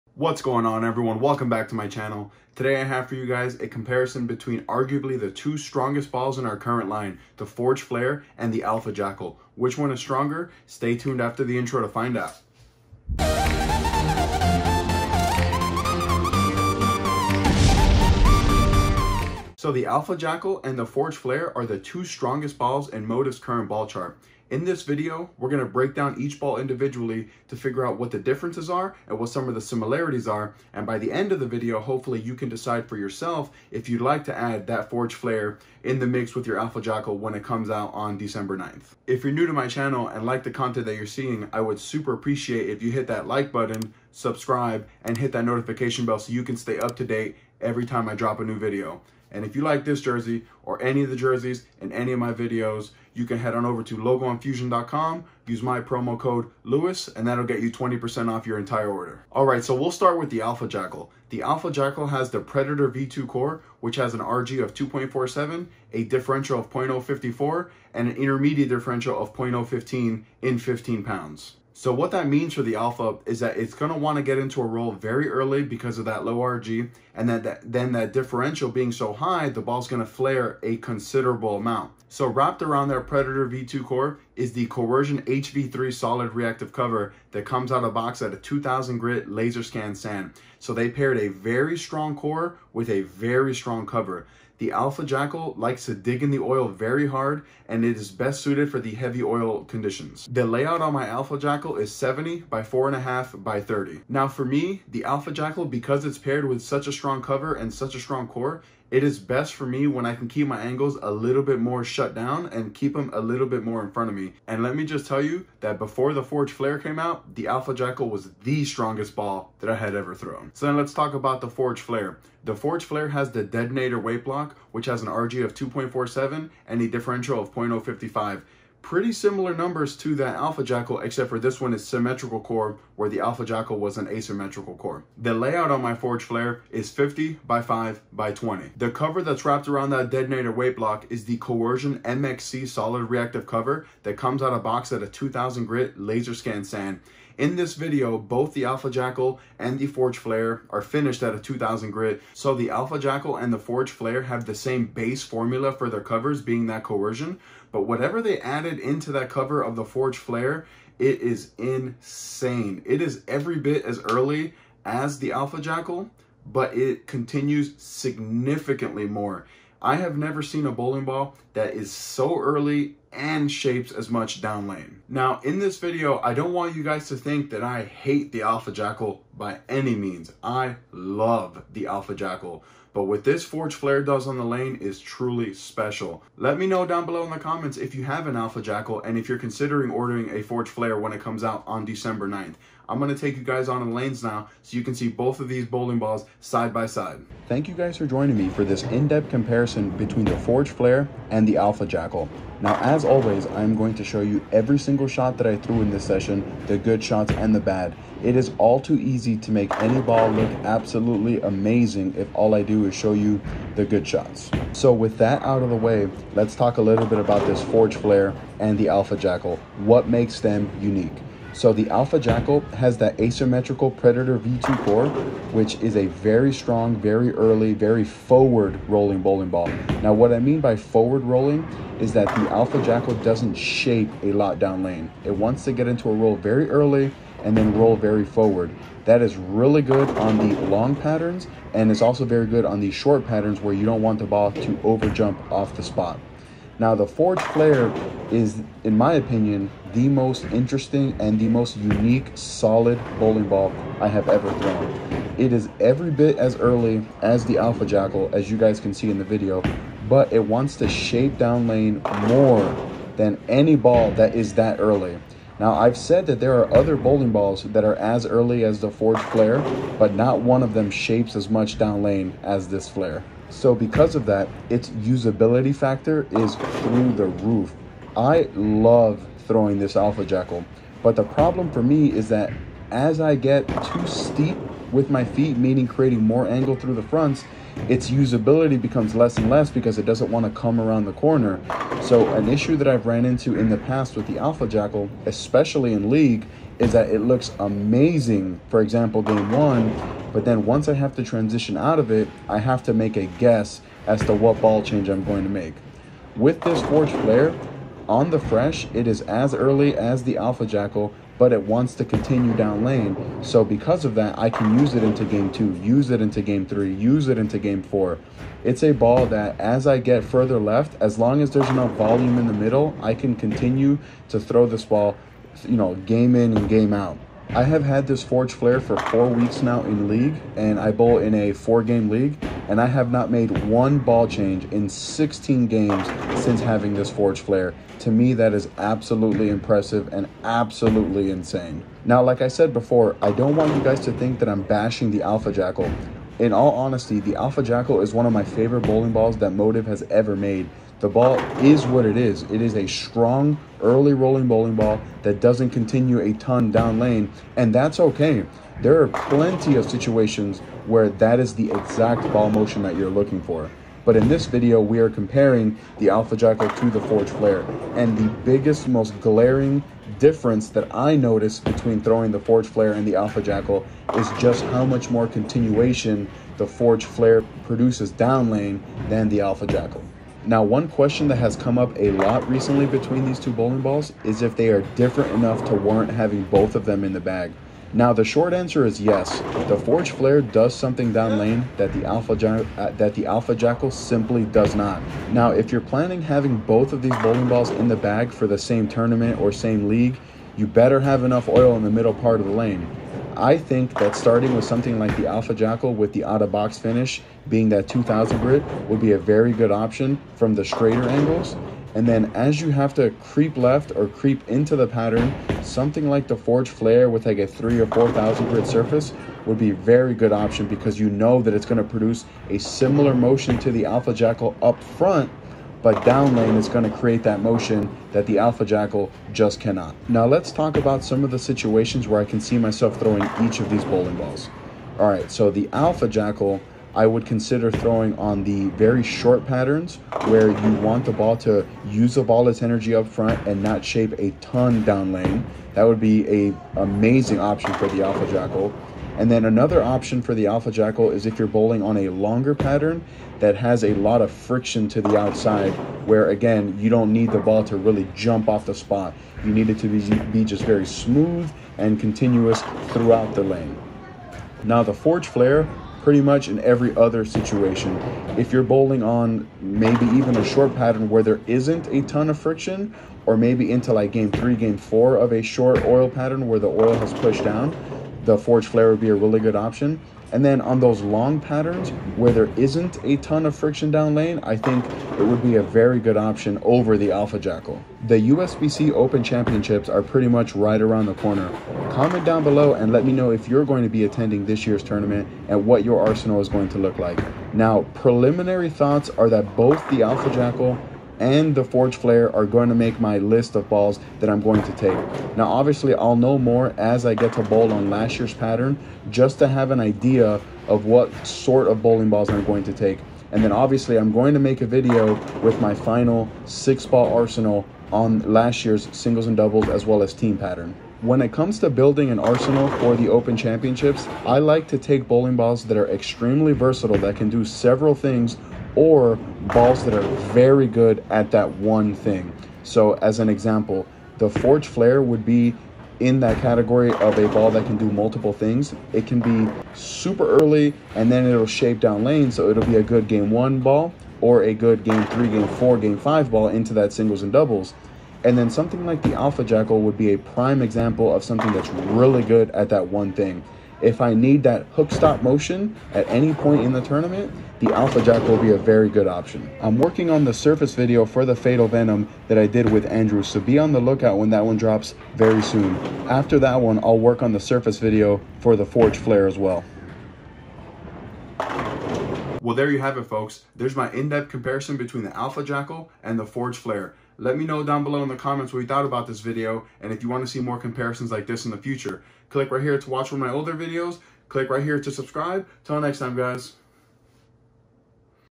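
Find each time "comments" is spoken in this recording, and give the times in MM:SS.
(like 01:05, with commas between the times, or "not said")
03:07, 08:11, 09:38.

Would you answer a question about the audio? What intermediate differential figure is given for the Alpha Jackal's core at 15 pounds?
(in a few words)
0.015.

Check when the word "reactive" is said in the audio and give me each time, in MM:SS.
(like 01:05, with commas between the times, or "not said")
01:26, 02:23.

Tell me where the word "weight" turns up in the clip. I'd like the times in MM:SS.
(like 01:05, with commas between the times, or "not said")
02:03, 02:20.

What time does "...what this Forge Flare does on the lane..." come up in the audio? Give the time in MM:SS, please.
03:03.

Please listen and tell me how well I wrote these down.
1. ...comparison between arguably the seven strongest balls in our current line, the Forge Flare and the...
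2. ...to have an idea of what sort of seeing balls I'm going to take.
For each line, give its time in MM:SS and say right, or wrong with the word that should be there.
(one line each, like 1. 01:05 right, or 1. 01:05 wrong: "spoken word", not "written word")
1. 00:03 wrong: "two", not "seven"
2. 08:29 wrong: "bowling", not "seeing".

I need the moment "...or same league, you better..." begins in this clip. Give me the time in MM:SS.
06:39.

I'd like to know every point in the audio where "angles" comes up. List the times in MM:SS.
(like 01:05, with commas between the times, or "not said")
01:50, 04:46, 06:51.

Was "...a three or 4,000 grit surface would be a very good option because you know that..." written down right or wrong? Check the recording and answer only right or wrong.
right.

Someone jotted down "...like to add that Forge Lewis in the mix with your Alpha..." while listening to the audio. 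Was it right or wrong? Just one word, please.
wrong.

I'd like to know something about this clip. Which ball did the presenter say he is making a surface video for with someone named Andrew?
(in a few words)
Fatal Venom.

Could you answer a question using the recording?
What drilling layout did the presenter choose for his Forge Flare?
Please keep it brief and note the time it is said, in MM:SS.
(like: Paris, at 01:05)
50 by 5 by 20, at 02:16.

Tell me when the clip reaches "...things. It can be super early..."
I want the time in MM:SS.
08:58.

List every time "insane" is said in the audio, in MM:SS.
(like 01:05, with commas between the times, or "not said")
02:41, 05:41.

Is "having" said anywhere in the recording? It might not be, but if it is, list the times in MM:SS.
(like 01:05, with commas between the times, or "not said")
05:36, 06:26, 06:36.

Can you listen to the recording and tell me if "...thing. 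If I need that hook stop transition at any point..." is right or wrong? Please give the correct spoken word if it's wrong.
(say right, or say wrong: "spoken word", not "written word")
wrong: "motion", not "transition".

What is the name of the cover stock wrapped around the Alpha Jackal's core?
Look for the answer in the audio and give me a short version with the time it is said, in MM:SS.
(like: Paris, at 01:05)
Coercion HV3, at 01:24.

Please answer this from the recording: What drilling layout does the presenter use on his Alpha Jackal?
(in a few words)
70 by 4.5 by 30.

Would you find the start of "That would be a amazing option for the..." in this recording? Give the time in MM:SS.
07:25.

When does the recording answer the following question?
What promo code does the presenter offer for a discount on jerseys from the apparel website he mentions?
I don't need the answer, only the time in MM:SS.
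00:56.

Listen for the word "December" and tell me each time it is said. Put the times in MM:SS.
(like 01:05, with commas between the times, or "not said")
00:38, 03:11.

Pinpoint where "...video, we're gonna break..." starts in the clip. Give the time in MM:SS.
00:24.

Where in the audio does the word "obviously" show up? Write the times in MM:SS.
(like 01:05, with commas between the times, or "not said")
08:25, 08:33.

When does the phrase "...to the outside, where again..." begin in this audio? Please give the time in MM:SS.
07:34.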